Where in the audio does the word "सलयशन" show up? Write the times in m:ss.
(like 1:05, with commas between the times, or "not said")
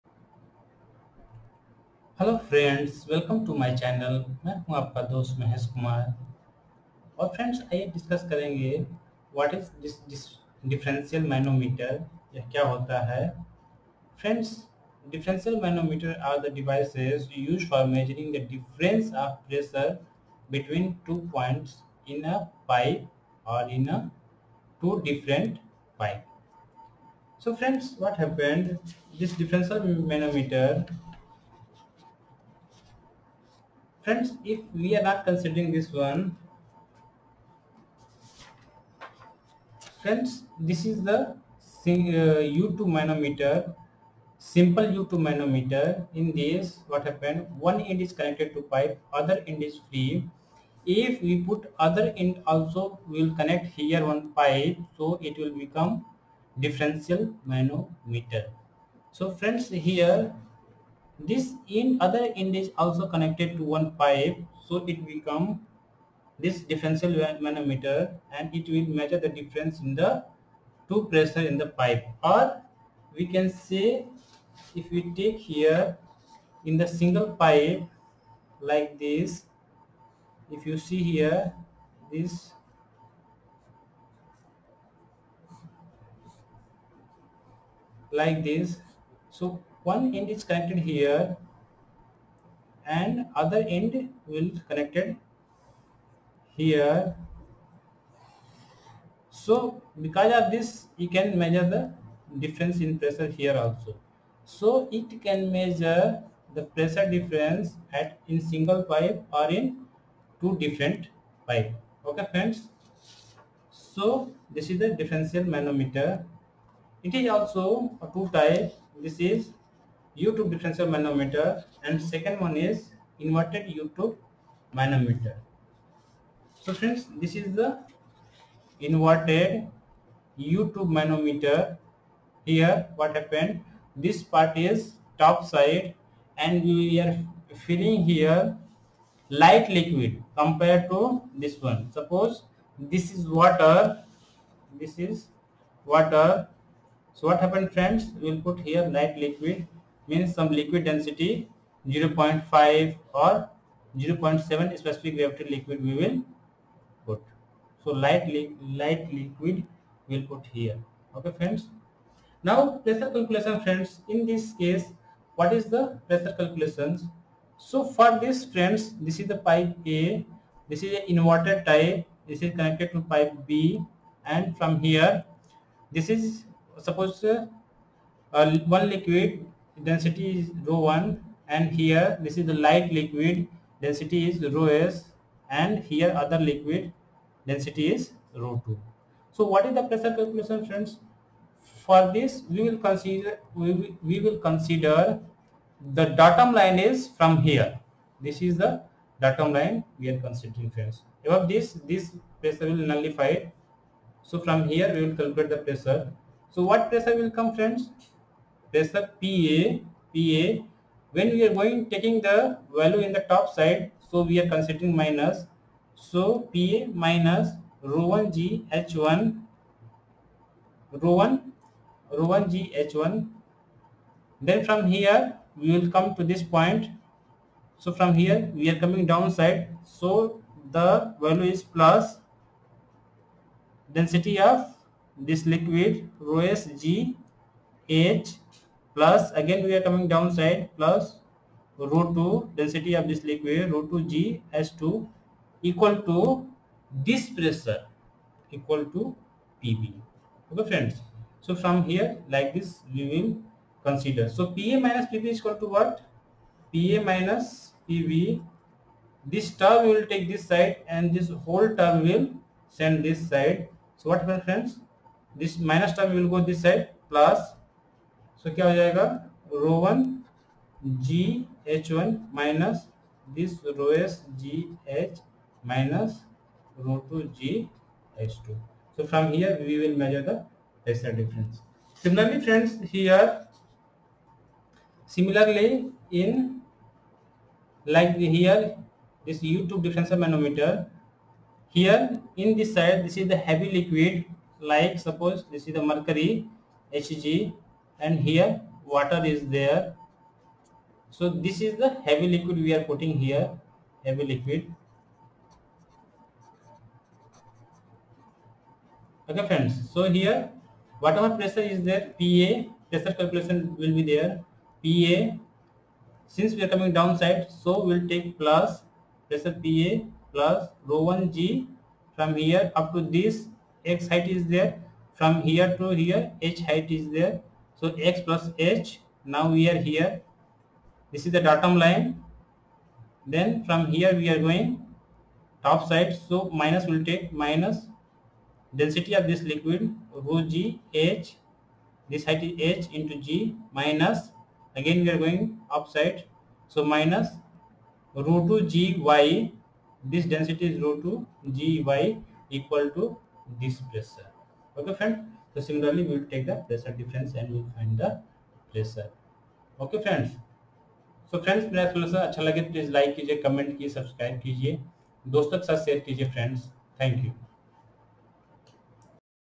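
6:01.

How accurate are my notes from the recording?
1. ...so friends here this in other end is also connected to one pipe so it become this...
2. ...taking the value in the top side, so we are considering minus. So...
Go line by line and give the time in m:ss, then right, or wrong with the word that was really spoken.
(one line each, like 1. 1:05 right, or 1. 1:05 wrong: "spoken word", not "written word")
1. 0:59 right
2. 3:31 right.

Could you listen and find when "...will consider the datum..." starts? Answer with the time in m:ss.
3:14.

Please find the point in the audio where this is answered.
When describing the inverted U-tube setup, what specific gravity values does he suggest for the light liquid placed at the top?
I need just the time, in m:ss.
2:31.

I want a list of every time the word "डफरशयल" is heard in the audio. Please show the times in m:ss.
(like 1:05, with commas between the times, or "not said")
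0:10, 0:15, 0:29.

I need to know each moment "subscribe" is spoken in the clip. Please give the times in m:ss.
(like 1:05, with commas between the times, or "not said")
6:04.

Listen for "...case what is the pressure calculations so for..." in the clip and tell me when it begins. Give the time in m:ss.
2:44.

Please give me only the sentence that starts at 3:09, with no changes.
So what is the pressure calculation friends?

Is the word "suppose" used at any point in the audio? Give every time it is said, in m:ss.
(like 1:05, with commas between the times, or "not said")
2:21, 2:56.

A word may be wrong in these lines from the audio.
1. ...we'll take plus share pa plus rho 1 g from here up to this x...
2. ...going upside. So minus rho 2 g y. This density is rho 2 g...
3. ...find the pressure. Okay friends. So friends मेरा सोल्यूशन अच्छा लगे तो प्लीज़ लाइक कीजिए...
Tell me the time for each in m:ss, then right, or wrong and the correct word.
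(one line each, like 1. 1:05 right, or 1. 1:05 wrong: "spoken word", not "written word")
1. 5:17 wrong: "pressure", not "share"
2. 5:45 right
3. 5:57 right.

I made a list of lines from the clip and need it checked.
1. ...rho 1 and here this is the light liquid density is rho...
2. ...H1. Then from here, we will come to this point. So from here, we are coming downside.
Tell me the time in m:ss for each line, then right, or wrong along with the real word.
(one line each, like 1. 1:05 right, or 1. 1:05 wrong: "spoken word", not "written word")
1. 3:00 right
2. 3:42 right.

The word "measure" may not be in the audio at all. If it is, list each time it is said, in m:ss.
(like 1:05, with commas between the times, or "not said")
1:08, 1:41, 1:45.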